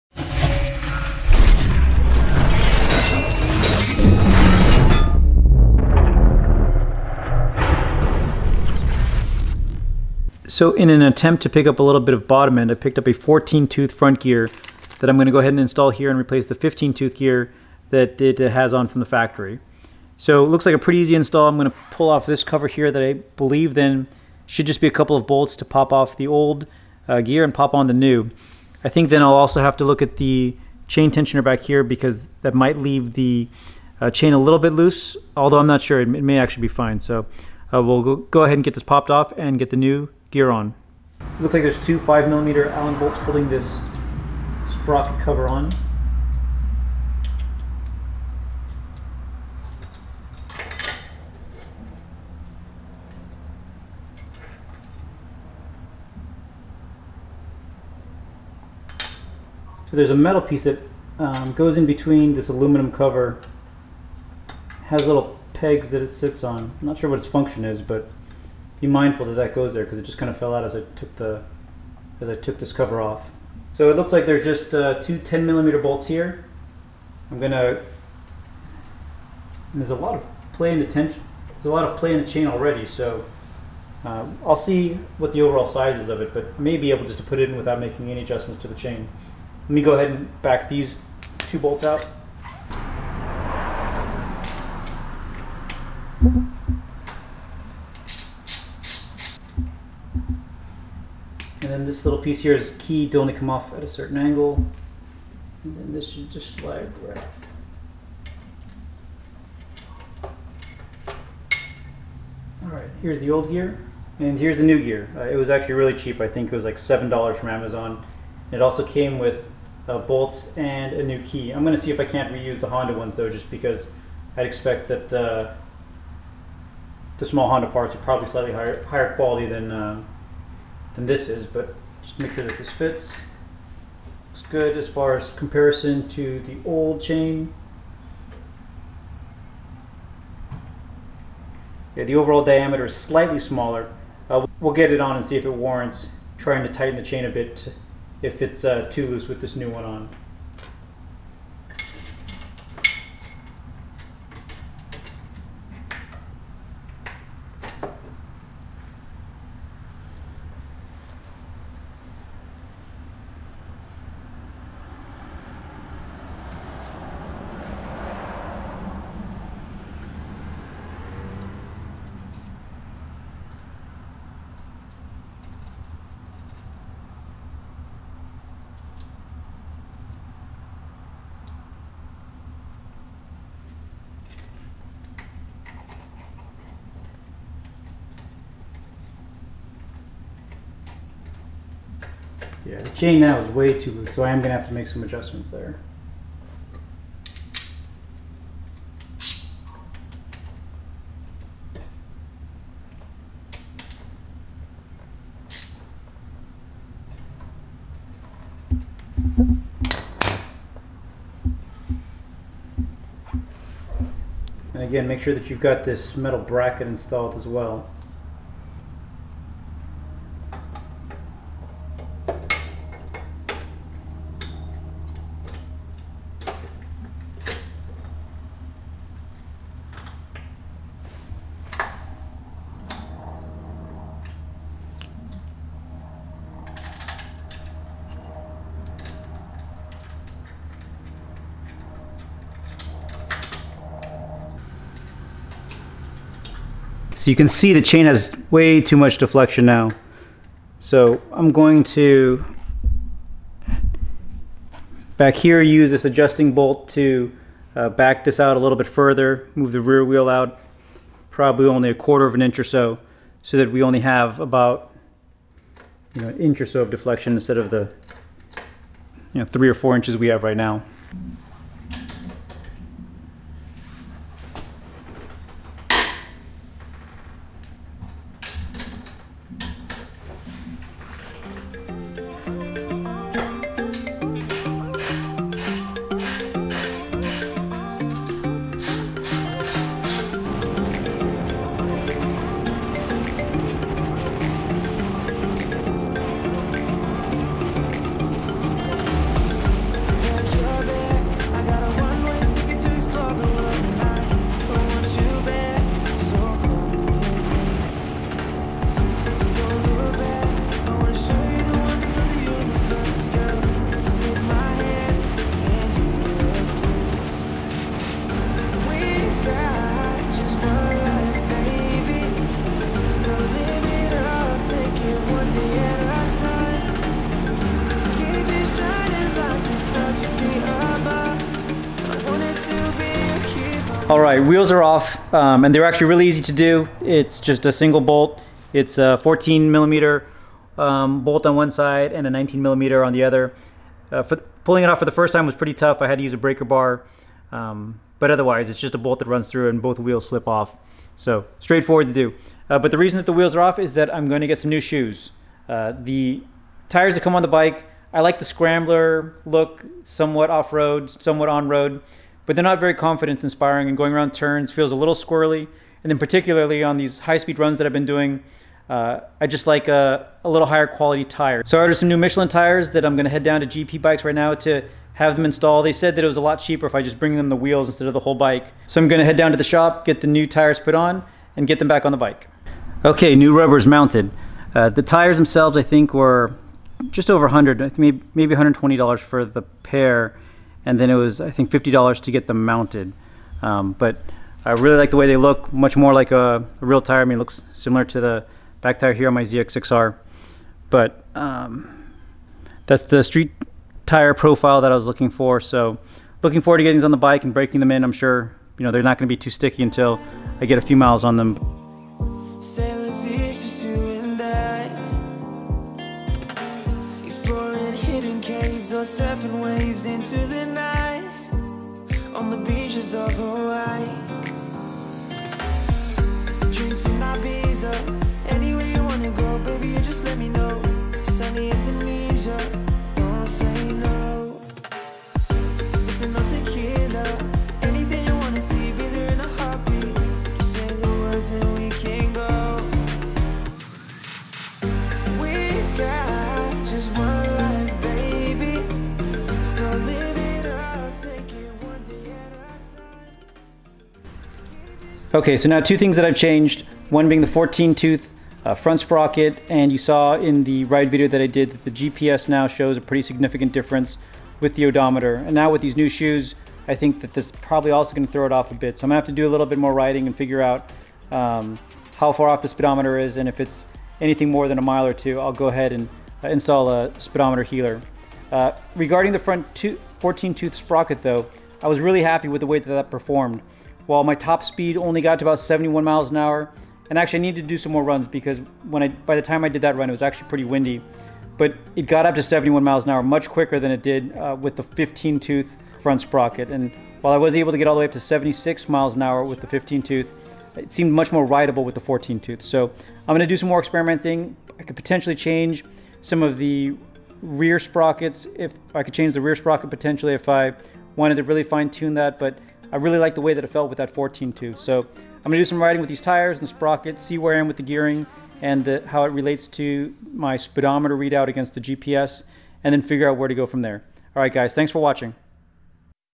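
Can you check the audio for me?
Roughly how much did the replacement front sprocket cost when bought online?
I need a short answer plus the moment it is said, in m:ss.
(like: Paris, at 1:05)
$7, at 1:56.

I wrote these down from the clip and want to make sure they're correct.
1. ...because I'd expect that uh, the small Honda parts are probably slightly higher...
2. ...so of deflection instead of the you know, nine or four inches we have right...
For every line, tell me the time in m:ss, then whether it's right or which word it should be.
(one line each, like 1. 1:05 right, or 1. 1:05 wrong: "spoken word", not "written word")
1. 2:03 right
2. 4:26 wrong: "three", not "nine".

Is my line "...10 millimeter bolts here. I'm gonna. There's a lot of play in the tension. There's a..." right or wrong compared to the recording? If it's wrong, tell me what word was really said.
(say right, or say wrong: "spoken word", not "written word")
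right.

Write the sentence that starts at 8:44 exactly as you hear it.
All right, guys, thanks for watching.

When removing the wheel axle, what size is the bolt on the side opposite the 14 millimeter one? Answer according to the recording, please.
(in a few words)
19 millimeter.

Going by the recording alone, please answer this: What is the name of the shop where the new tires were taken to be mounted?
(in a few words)
GP Bikes.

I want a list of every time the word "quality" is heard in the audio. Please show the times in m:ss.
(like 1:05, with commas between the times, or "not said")
2:09, 6:10.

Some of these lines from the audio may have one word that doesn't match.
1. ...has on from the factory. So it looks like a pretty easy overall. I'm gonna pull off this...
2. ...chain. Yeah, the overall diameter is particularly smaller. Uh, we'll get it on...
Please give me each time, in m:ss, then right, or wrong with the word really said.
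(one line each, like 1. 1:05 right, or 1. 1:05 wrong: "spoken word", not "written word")
1. 0:18 wrong: "install", not "overall"
2. 2:17 wrong: "slightly", not "particularly".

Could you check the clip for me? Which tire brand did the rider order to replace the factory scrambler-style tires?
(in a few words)
Michelin.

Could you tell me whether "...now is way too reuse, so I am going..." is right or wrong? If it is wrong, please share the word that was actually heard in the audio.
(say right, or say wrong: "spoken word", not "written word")
wrong: "loose", not "reuse".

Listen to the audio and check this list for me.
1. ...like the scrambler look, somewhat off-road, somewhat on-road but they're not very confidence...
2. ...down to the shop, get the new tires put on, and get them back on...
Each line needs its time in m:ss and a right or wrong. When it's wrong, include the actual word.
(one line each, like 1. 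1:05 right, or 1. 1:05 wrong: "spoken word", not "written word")
1. 5:58 right
2. 6:19 right.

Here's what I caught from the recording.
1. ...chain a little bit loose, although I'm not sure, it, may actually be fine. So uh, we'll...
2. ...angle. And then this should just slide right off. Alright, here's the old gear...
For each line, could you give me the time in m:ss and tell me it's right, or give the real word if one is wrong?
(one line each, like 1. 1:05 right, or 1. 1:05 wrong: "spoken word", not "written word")
1. 0:34 right
2. 1:44 right.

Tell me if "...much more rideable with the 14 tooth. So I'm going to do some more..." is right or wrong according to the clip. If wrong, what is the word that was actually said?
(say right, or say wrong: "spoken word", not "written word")
right.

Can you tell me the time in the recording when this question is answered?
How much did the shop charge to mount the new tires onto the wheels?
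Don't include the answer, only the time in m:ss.
6:31.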